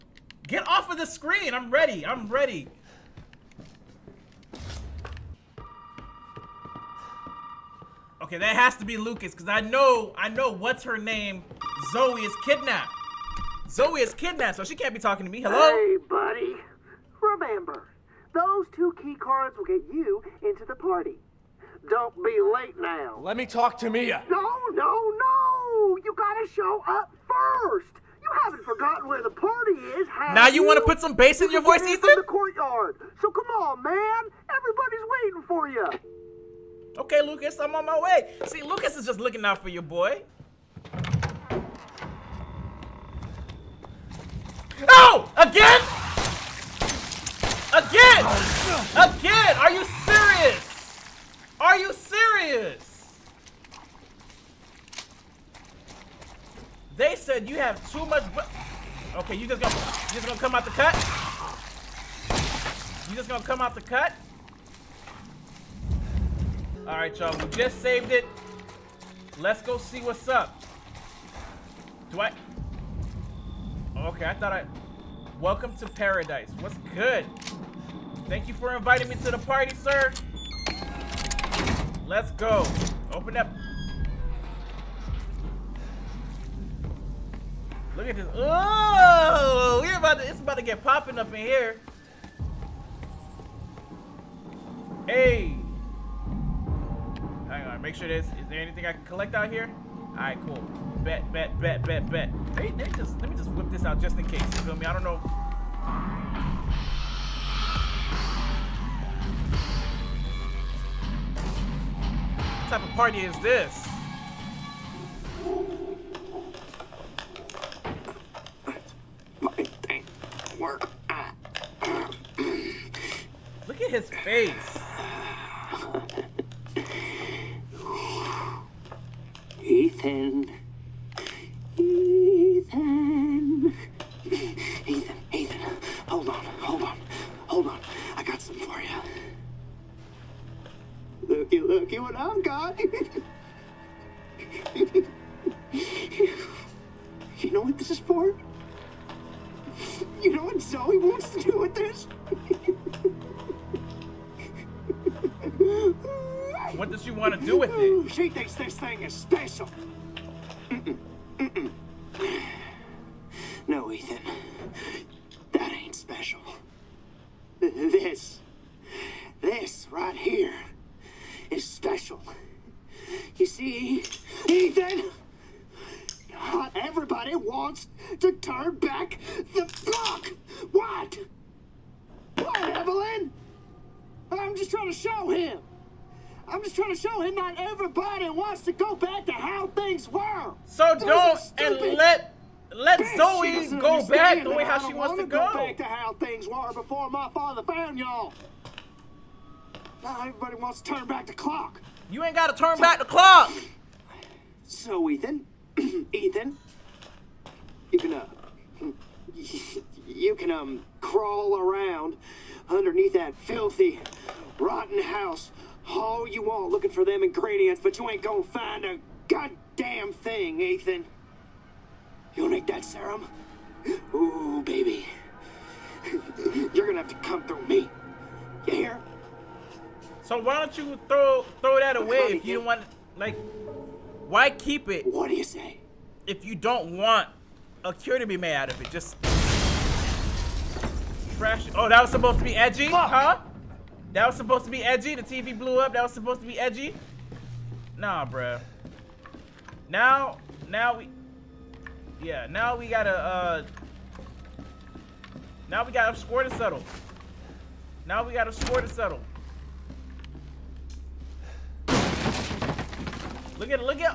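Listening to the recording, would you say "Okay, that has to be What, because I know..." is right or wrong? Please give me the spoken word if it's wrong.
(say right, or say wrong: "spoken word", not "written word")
wrong: "Lucas", not "What".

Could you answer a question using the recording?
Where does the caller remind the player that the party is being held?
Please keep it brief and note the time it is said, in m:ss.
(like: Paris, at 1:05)
the courtyard, at 0:32.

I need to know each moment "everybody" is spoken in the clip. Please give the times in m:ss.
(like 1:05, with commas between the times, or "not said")
0:34, 2:56, 3:07, 3:20.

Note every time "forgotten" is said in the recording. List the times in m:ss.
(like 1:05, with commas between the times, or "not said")
0:28.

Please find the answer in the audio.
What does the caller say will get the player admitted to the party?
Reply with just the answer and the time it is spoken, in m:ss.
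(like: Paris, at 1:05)
key cards, at 0:19.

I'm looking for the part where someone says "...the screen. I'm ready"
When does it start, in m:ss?
0:00.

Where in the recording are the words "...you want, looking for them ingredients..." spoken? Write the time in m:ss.
3:36.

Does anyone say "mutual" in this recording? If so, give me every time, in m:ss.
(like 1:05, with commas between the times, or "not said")
not said.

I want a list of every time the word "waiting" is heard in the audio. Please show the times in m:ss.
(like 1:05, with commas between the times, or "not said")
0:35.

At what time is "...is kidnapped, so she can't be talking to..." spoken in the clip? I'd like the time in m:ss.
0:13.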